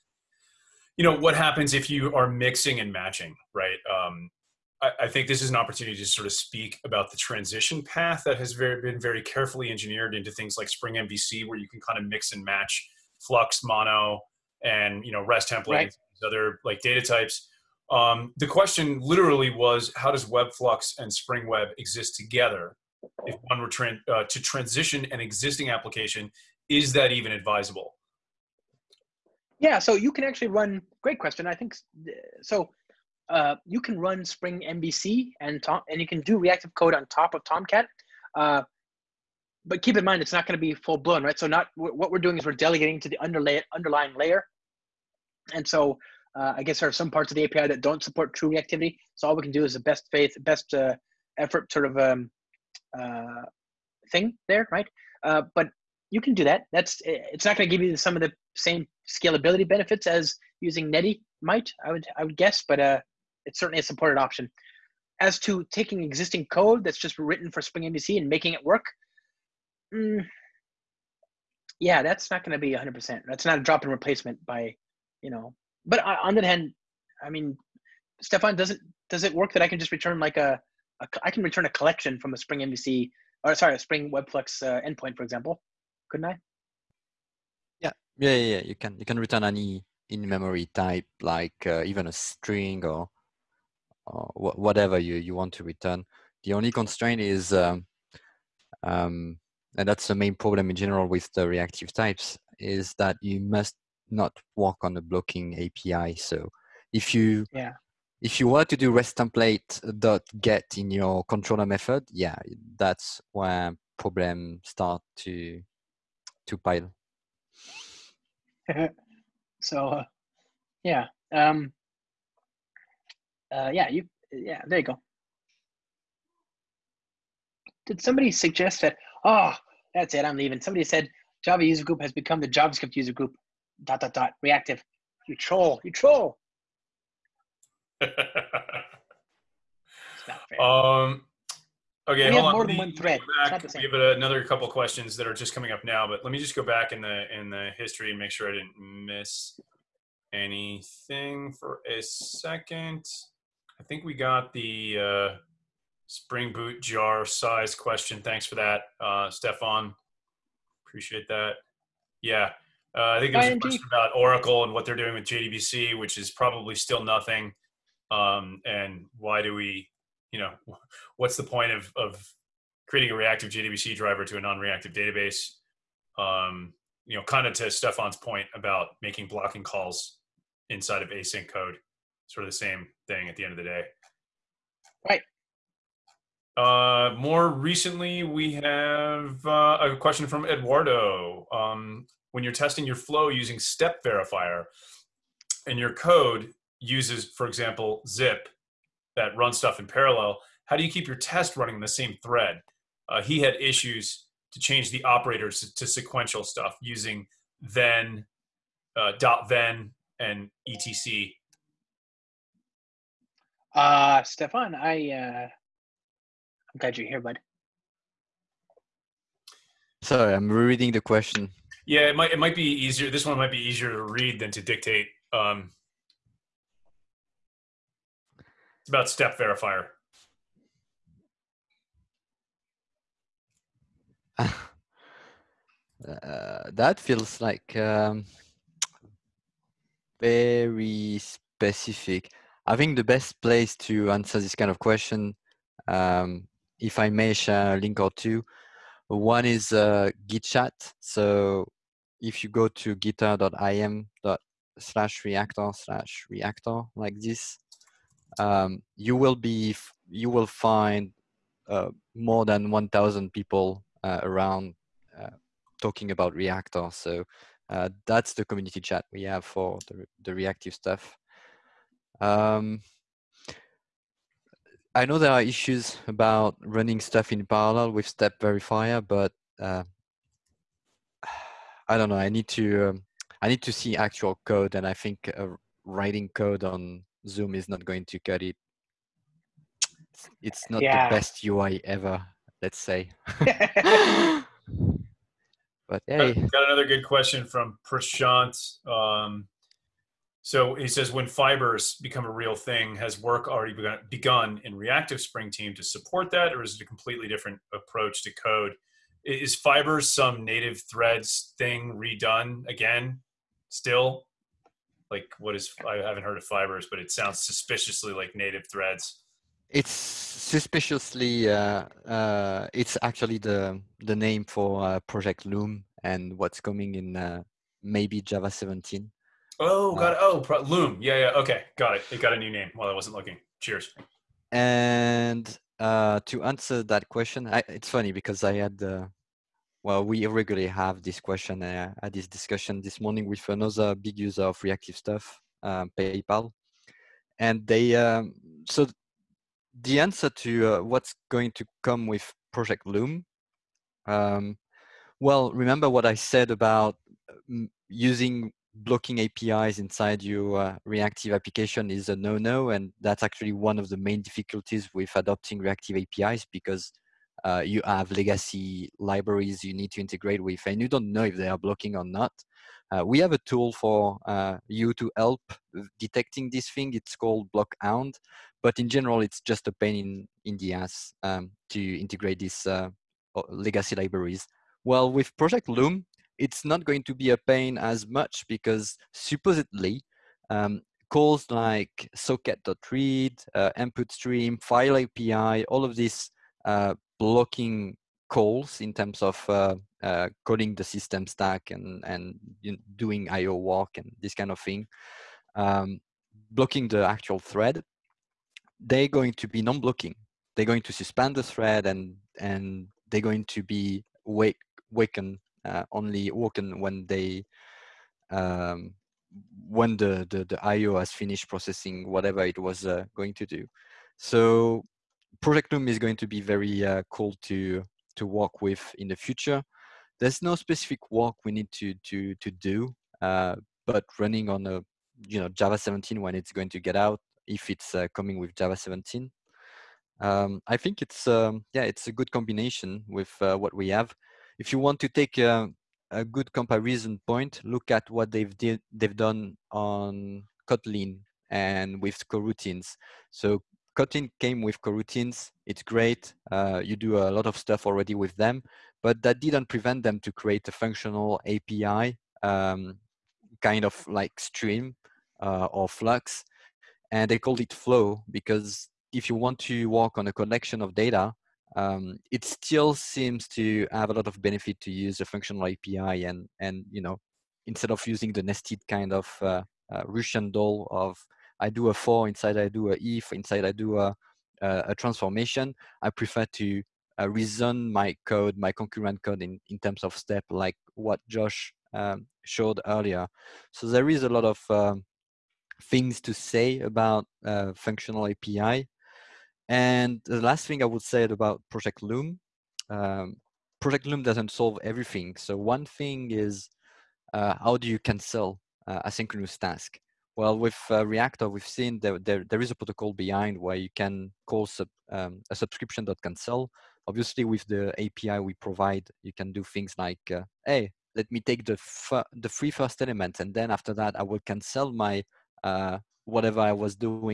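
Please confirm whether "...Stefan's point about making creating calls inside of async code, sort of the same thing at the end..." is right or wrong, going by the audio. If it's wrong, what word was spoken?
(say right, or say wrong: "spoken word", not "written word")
wrong: "blocking", not "creating".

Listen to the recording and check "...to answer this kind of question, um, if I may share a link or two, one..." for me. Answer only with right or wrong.
right.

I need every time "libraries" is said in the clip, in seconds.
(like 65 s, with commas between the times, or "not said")
368 s, 383 s.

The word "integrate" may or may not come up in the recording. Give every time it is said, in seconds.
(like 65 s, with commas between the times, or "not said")
369 s, 381 s.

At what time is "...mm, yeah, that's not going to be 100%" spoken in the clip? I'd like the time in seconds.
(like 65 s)
69 s.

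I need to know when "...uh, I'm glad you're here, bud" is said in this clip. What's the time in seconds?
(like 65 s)
215 s.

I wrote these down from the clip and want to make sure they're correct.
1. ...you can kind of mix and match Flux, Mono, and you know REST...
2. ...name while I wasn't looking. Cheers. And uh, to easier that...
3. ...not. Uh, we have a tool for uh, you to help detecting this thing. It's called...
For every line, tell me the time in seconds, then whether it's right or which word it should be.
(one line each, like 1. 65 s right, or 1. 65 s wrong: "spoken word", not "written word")
1. 11 s right
2. 332 s wrong: "answer", not "easier"
3. 372 s right.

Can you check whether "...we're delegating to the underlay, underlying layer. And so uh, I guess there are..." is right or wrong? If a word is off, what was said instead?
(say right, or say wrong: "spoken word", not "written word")
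right.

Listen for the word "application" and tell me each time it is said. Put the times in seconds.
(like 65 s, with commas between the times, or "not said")
25 s, 361 s.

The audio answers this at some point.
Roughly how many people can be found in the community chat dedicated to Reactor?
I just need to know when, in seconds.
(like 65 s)
262 s.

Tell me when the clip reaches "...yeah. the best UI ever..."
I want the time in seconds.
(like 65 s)
290 s.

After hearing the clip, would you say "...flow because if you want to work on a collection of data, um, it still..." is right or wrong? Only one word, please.
right.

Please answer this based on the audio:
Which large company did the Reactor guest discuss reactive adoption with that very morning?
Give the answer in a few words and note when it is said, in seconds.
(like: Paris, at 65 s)
PayPal, at 345 s.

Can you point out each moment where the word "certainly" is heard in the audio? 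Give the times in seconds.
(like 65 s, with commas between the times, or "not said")
63 s.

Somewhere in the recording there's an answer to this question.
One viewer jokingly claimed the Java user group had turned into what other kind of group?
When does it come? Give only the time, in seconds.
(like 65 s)
132 s.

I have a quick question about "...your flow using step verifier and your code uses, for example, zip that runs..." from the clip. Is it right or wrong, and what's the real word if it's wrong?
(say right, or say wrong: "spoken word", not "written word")
right.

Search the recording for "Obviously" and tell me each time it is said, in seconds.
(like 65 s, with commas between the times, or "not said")
517 s.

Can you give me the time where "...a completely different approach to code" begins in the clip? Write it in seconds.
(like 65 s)
306 s.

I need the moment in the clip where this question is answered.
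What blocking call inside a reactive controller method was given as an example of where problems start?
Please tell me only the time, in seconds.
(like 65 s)
108 s.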